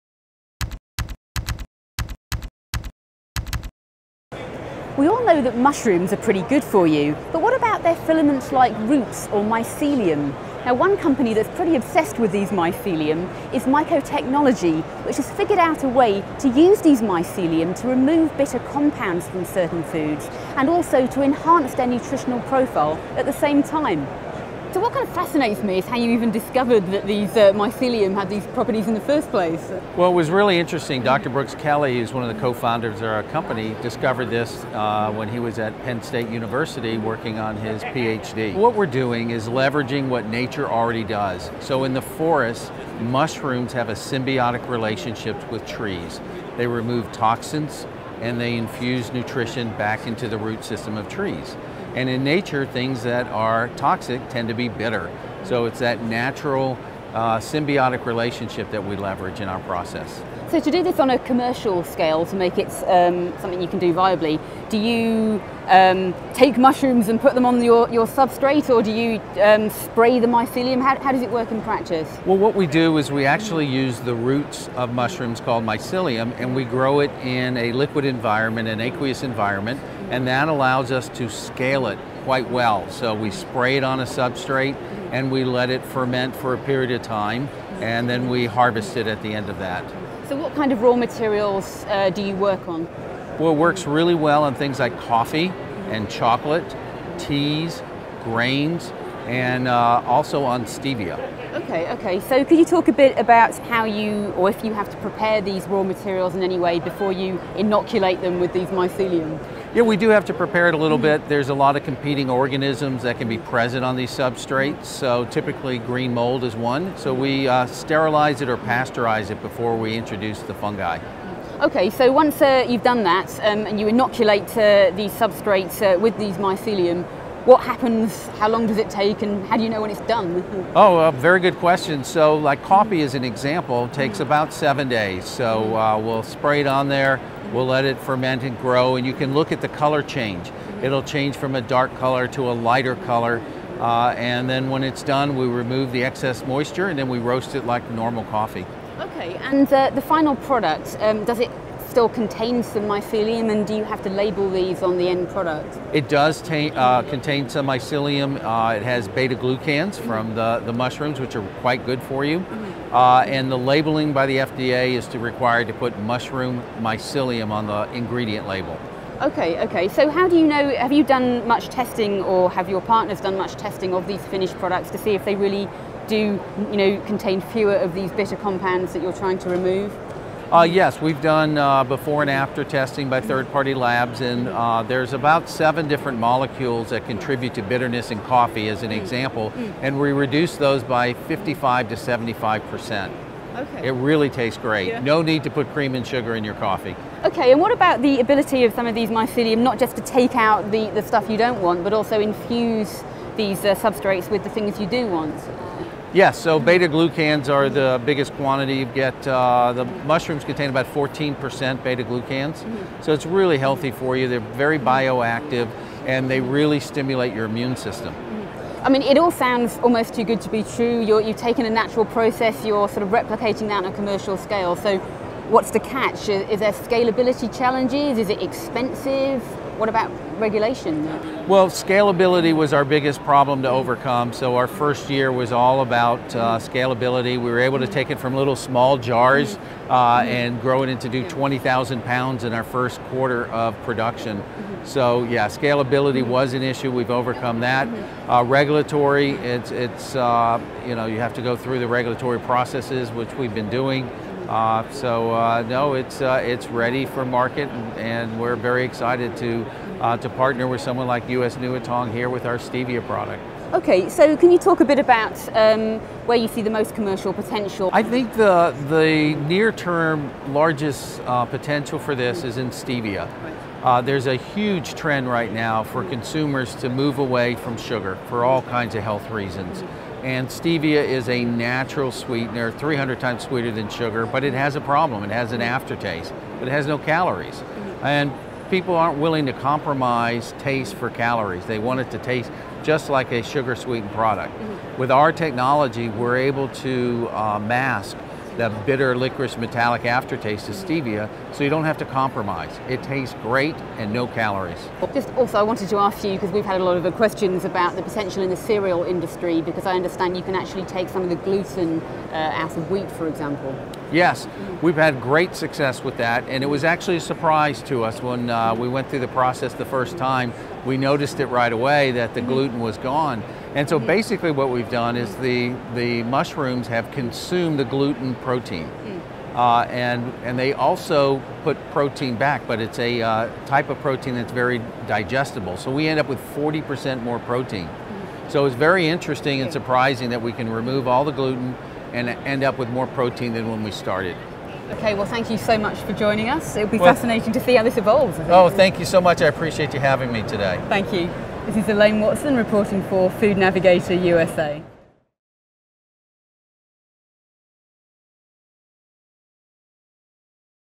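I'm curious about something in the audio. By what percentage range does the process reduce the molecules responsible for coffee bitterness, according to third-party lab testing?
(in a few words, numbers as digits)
55 to 75 percent.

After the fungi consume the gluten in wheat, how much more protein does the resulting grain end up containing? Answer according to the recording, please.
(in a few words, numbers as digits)
40%.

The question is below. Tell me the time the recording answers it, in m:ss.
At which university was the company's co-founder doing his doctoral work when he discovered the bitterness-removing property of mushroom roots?
0:35.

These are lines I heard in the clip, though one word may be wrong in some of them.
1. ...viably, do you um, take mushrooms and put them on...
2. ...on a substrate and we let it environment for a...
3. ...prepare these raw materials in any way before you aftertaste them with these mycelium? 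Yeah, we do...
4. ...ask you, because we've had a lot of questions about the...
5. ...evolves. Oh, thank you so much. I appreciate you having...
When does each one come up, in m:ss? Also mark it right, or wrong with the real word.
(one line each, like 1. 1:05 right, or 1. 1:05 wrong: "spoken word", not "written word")
1. 1:03 right
2. 1:23 wrong: "ferment", not "environment"
3. 1:44 wrong: "inoculate", not "aftertaste"
4. 5:05 right
5. 5:47 right.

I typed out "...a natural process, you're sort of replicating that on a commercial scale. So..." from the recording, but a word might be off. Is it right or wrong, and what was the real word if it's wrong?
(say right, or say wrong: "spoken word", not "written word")
right.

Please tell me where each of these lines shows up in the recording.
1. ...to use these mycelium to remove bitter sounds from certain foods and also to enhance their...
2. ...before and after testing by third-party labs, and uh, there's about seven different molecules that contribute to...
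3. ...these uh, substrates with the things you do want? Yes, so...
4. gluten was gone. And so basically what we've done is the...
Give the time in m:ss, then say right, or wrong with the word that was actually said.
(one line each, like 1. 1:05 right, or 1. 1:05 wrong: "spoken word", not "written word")
1. 0:16 wrong: "compounds", not "sounds"
2. 3:01 right
3. 3:23 right
4. 5:22 right.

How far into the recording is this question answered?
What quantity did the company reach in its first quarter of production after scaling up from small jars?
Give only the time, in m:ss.
4:01.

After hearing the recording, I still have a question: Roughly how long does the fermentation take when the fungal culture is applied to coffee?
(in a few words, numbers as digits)
7 days.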